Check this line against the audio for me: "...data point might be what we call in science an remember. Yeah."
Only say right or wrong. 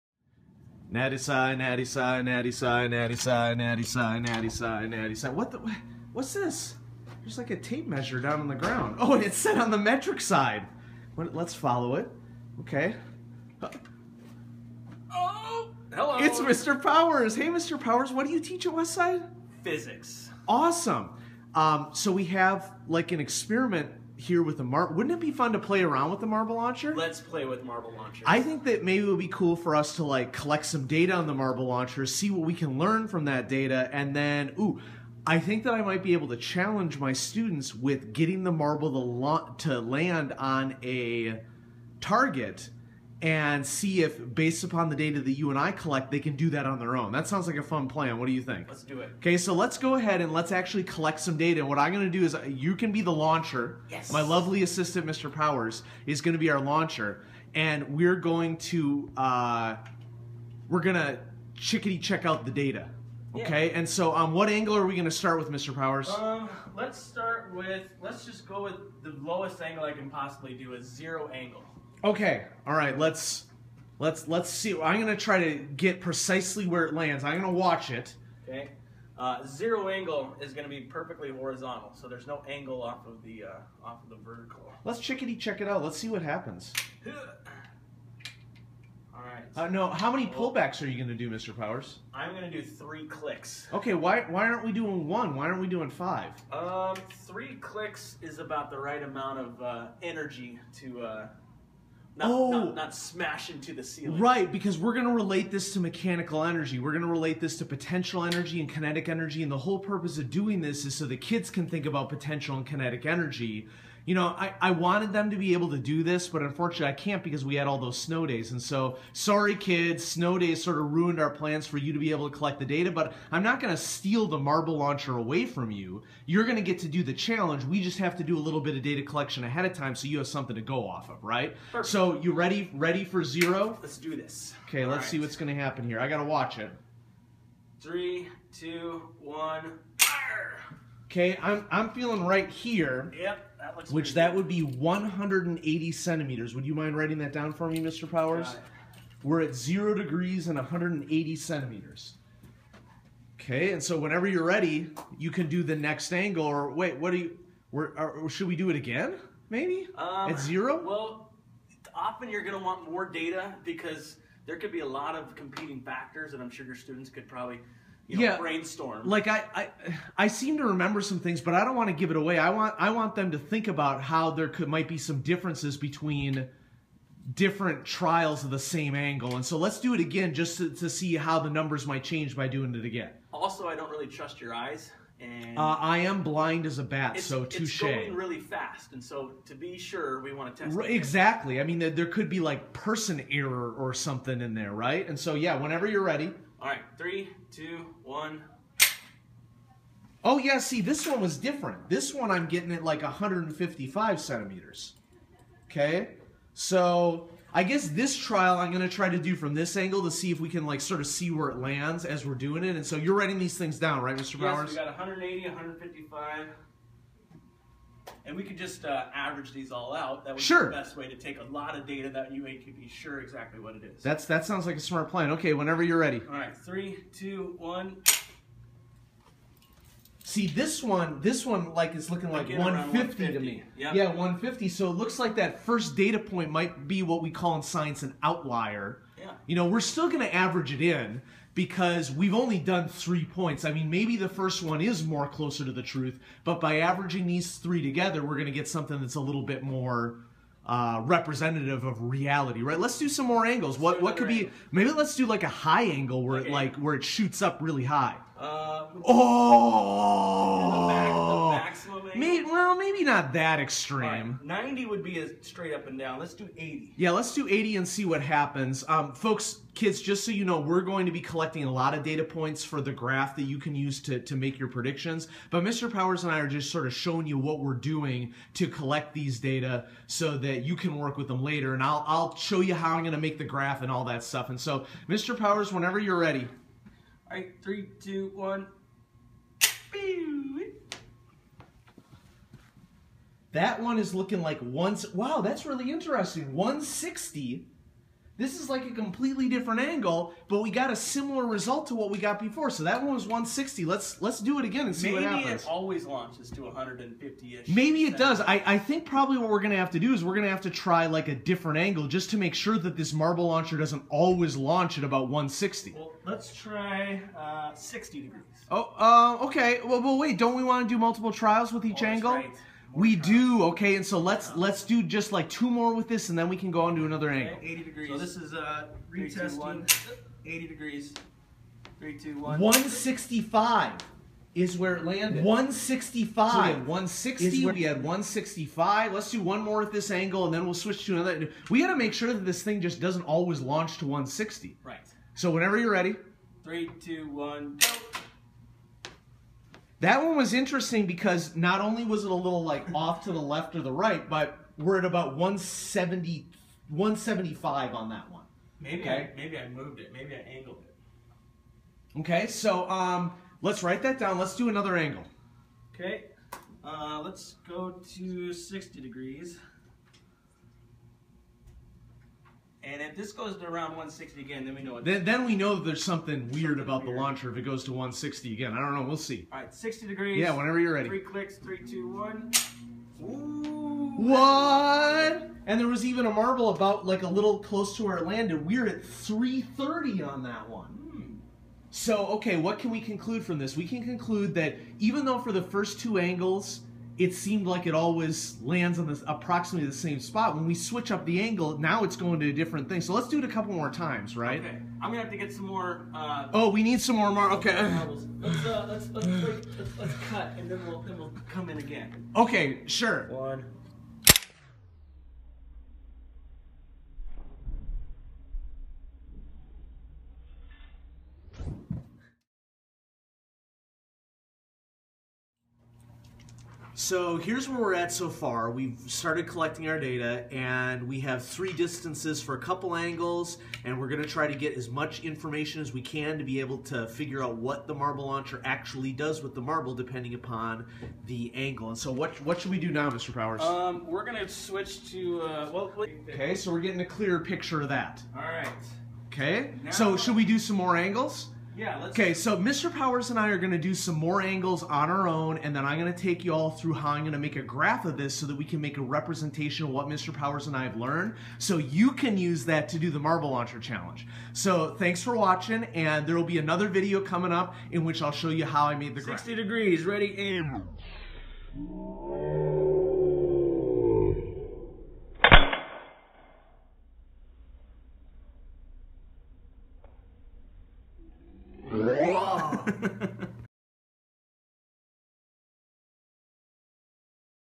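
wrong.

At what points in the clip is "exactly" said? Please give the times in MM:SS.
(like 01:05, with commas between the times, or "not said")
03:10, 03:43.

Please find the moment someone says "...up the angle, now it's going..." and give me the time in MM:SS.
06:41.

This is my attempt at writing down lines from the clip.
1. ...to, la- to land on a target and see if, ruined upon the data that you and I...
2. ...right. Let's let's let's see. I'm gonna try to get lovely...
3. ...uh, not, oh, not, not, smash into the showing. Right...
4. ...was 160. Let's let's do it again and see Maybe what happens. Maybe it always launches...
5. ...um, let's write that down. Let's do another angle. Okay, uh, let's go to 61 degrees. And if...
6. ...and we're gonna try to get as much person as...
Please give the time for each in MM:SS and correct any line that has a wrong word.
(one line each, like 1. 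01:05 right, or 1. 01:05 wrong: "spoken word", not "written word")
1. 00:38 wrong: "based", not "ruined"
2. 01:12 wrong: "precisely", not "lovely"
3. 01:41 wrong: "ceiling", not "showing"
4. 05:03 right
5. 06:02 wrong: "60", not "61"
6. 07:13 wrong: "information", not "person".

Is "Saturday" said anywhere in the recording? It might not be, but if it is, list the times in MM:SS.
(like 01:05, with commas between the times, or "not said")
not said.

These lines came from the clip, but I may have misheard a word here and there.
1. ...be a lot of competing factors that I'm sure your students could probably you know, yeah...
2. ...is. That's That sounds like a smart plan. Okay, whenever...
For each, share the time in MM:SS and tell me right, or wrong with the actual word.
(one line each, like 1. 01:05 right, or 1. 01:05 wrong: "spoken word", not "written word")
1. 02:44 right
2. 03:43 right.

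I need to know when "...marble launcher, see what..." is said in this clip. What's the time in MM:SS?
00:31.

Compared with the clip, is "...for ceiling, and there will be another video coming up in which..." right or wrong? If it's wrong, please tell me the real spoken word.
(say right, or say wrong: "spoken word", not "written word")
wrong: "watching", not "ceiling".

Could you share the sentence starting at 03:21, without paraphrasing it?
This one I'm getting at like 155 centimeters.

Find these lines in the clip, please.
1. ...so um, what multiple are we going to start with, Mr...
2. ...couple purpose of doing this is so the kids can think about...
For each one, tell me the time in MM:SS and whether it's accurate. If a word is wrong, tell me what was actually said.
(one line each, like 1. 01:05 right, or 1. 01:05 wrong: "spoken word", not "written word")
1. 01:03 wrong: "angle", not "multiple"
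2. 01:49 wrong: "whole", not "couple".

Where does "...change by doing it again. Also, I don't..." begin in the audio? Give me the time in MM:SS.
03:02.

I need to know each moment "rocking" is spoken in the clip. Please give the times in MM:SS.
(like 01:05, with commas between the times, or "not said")
not said.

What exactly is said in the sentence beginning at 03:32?
And so you're writing these things down, right, Mr.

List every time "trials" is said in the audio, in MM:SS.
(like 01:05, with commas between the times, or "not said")
02:57, 03:28, 05:21.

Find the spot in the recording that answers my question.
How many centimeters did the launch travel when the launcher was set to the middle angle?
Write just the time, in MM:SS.
06:29.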